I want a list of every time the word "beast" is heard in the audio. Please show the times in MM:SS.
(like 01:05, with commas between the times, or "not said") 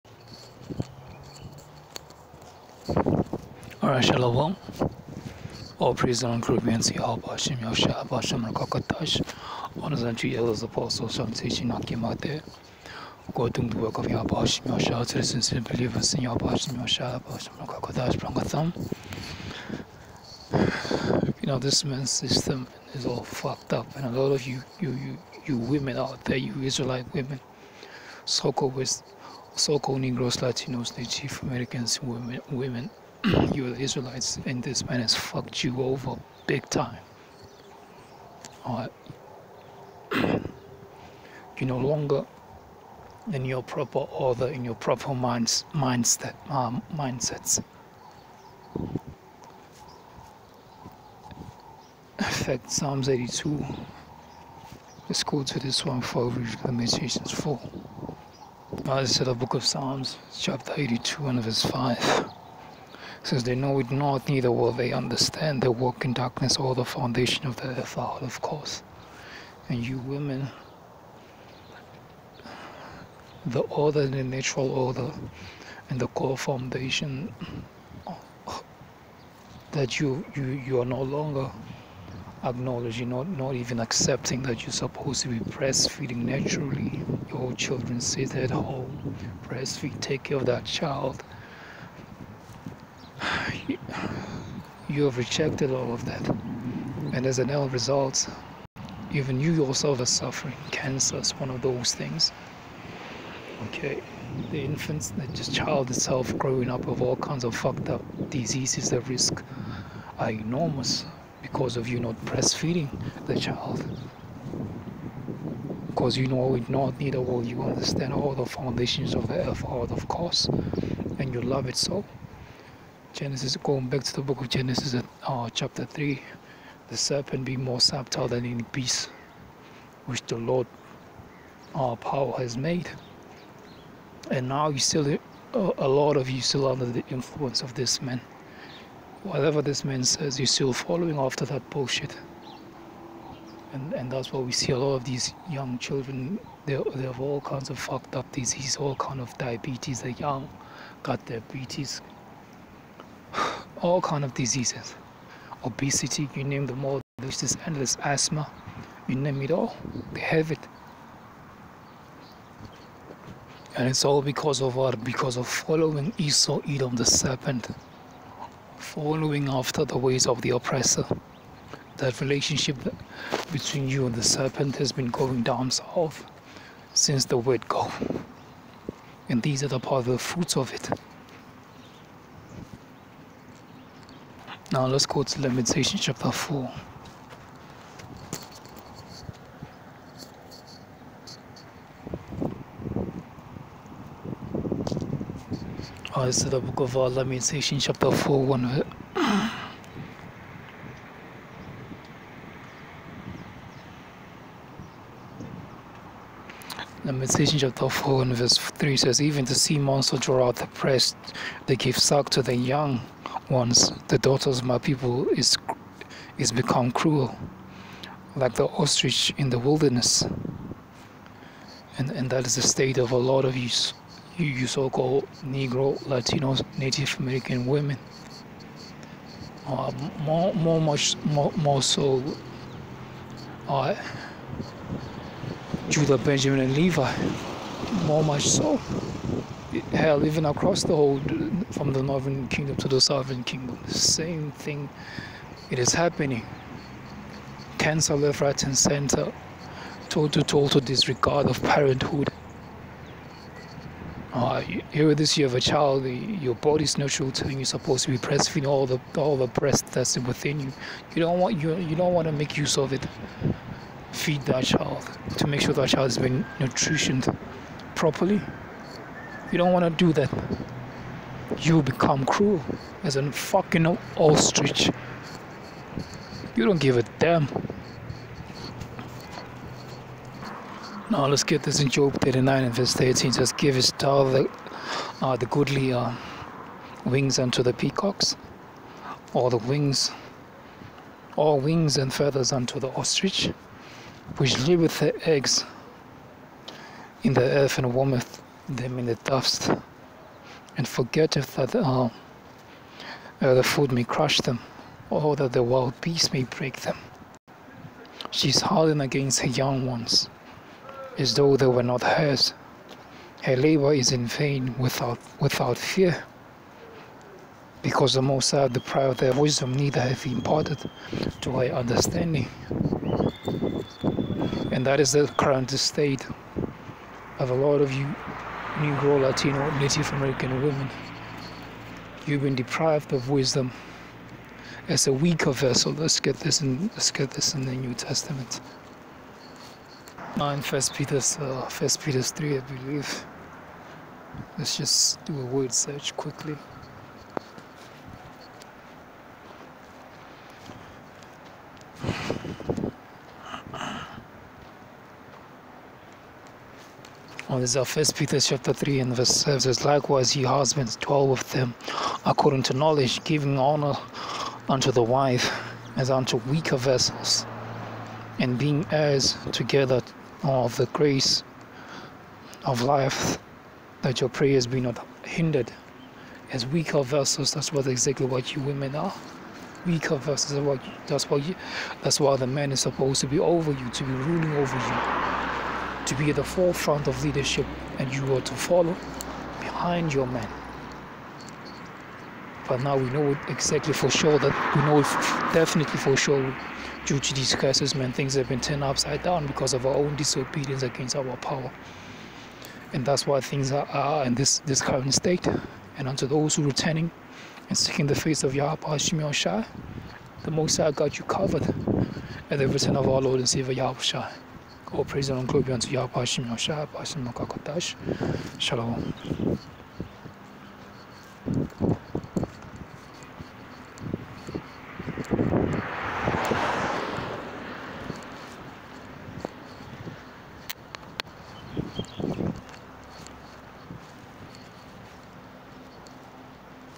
02:08, 05:05.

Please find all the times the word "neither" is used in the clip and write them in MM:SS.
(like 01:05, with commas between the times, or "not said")
01:04, 01:56, 05:19.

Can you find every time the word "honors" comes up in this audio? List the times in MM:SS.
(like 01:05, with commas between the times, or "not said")
00:09, 06:03.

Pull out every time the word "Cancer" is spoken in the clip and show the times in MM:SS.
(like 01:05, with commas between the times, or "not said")
01:40, 04:07.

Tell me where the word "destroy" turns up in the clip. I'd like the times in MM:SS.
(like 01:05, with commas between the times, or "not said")
not said.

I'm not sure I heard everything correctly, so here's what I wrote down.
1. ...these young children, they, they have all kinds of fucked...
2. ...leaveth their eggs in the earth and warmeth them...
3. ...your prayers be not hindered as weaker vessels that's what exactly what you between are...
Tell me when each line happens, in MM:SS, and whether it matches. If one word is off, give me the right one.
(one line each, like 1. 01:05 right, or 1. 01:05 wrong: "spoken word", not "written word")
1. 02:25 right
2. 04:54 right
3. 06:14 wrong: "women", not "between".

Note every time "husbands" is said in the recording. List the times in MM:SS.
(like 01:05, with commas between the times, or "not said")
06:00.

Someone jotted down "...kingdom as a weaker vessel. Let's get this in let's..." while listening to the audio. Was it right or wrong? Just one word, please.
wrong.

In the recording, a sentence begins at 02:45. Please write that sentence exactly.
Because of following Esau, Edom, the serpent following after the ways of the oppressor.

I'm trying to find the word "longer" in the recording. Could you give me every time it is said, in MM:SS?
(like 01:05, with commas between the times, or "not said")
00:41, 01:21.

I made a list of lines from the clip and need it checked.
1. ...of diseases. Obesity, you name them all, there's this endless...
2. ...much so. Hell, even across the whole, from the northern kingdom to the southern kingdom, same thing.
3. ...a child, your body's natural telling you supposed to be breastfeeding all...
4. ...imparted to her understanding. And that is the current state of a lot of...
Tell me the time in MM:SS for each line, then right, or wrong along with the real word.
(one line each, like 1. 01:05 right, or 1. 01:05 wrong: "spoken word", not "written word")
1. 02:34 right
2. 03:58 right
3. 04:15 right
4. 05:20 right.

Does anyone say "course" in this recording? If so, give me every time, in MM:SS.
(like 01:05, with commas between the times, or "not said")
01:08, 02:00.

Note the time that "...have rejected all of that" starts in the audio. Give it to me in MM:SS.
01:35.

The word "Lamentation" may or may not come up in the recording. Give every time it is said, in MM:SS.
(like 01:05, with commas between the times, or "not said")
03:05, 03:16, 03:27.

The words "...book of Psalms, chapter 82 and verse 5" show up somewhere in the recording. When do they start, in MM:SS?
00:59.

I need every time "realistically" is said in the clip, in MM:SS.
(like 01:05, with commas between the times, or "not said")
not said.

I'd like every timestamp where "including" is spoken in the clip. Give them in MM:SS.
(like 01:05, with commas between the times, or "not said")
not said.